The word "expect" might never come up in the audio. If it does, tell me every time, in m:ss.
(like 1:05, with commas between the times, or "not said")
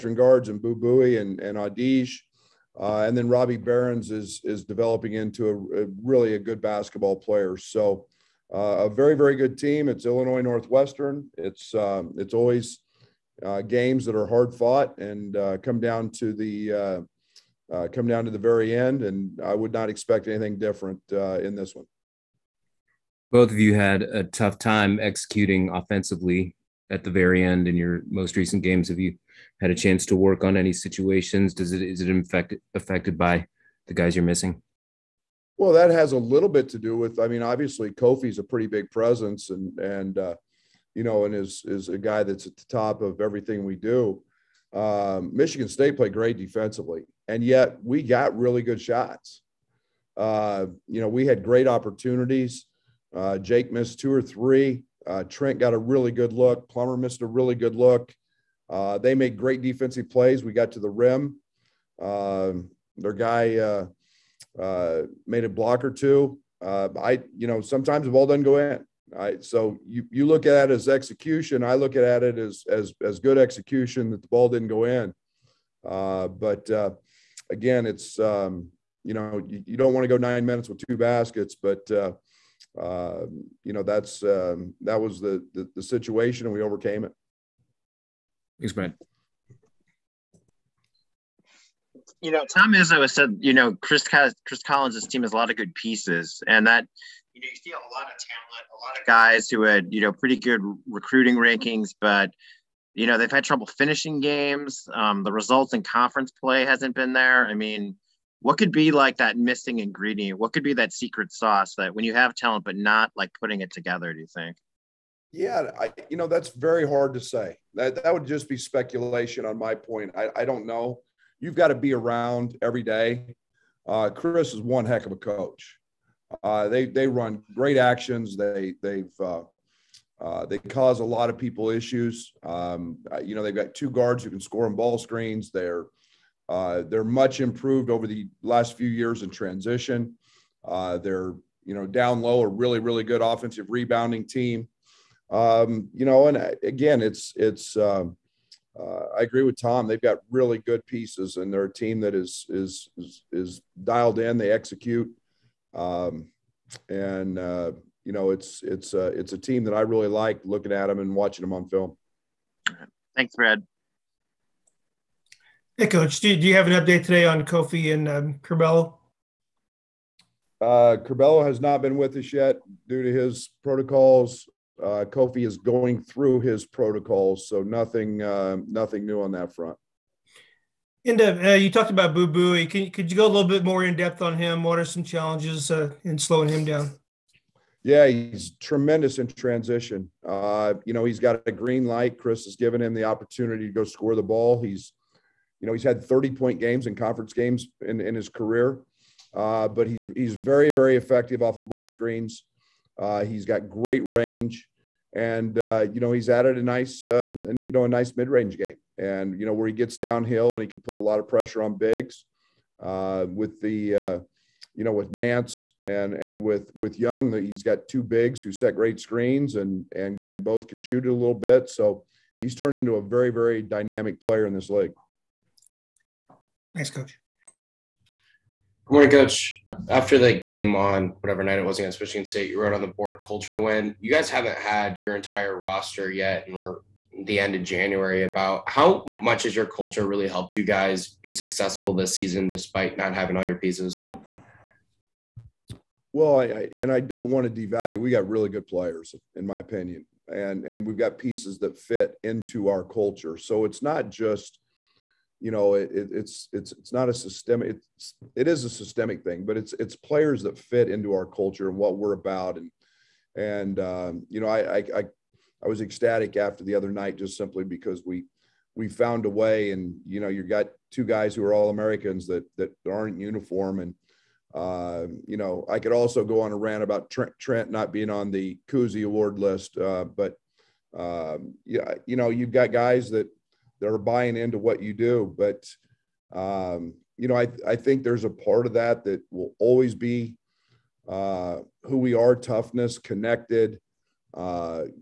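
0:19.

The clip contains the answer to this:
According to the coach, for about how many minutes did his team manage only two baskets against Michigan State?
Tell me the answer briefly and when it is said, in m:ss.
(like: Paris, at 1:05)
9, at 1:20.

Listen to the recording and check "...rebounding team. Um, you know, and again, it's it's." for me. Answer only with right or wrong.
right.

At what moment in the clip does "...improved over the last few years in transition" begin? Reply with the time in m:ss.
2:17.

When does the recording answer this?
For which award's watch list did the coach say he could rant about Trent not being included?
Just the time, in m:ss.
4:38.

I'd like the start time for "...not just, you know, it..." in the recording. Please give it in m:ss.
4:13.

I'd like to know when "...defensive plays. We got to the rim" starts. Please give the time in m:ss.
0:59.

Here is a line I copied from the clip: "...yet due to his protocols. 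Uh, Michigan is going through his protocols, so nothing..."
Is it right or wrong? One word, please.
wrong.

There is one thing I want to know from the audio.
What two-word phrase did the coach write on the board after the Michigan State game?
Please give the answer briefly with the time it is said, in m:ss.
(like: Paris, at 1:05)
Culture win, at 3:53.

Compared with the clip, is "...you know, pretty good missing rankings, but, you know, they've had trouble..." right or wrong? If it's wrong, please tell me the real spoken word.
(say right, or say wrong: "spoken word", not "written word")
wrong: "recruiting", not "missing".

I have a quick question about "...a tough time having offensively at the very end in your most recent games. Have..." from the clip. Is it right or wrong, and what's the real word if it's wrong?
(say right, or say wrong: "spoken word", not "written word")
wrong: "executing", not "having".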